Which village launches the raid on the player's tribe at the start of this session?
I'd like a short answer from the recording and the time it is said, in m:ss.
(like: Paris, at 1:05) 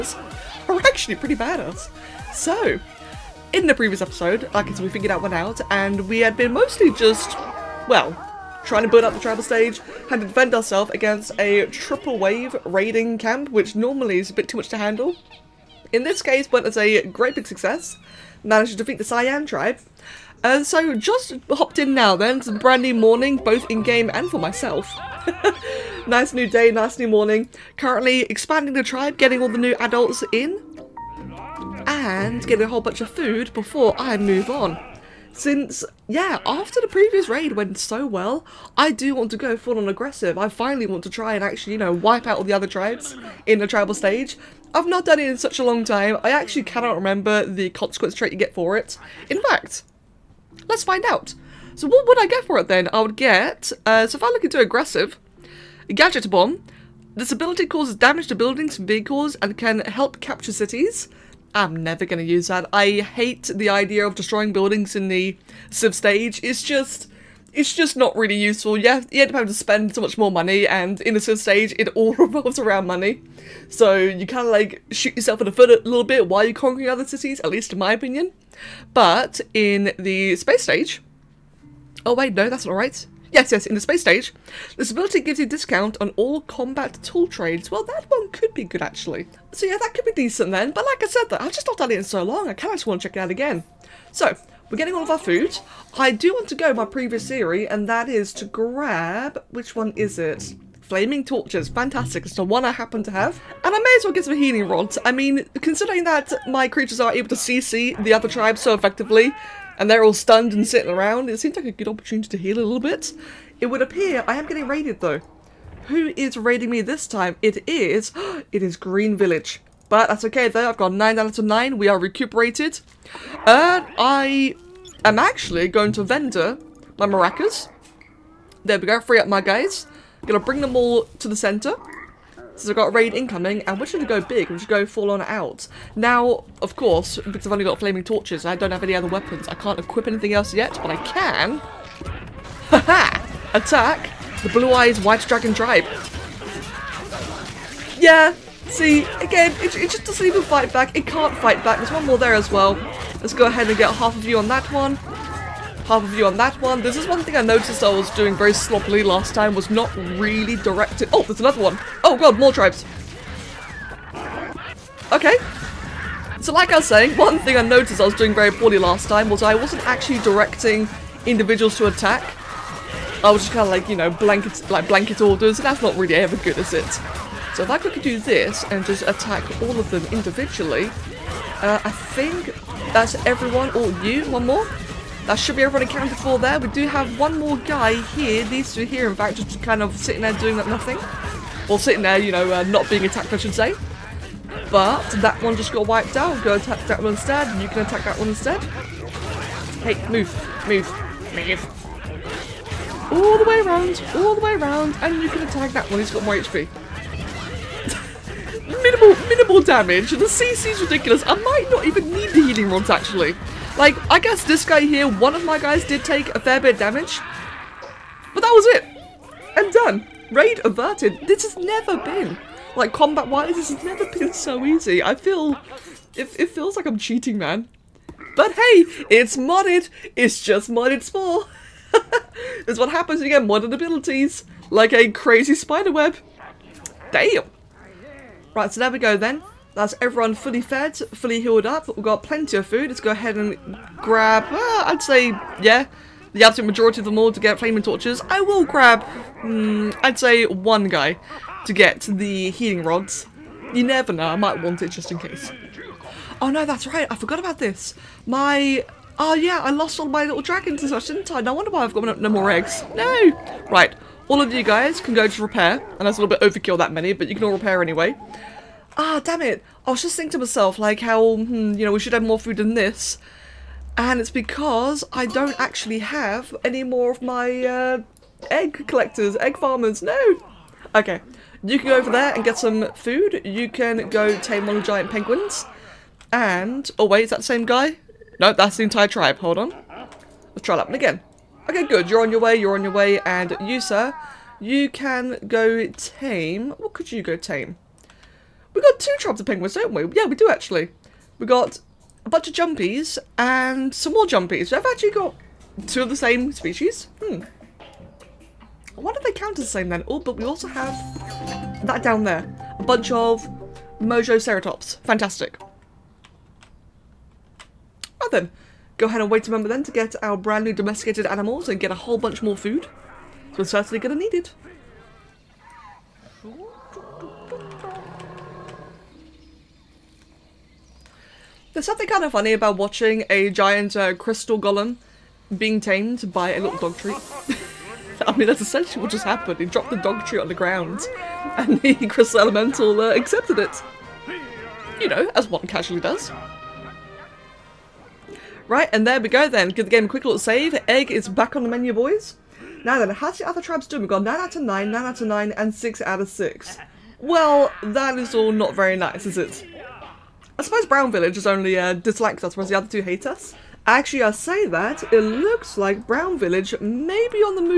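Green Village, at 1:58.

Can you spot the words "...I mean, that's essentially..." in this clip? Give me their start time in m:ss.
5:38.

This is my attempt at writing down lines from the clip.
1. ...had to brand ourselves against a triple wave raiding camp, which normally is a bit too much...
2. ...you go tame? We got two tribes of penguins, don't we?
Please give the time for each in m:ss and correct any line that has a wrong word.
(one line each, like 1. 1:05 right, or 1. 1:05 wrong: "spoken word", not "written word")
1. 0:10 wrong: "defend", not "brand"
2. 4:57 right.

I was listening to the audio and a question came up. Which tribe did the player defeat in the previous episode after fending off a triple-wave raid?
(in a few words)
cyan tribe.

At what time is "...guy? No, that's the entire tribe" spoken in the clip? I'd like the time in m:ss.
4:47.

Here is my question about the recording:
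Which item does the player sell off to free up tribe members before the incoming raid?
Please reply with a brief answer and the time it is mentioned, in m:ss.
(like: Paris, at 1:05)
maracas, at 2:07.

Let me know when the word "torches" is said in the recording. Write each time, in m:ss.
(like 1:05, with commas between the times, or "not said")
1:41, 2:18, 4:07.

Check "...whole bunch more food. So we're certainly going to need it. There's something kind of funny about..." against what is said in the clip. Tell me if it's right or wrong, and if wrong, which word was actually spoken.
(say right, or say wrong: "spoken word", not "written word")
right.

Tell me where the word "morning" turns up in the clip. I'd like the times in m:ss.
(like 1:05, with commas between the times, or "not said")
0:22, 0:27.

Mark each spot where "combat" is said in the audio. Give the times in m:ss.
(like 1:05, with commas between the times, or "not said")
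1:26, 3:42.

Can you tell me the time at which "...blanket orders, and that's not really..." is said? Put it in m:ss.
2:54.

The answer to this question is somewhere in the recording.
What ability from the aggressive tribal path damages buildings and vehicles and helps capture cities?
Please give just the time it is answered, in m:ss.
0:55.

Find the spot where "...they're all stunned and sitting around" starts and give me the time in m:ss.
1:49.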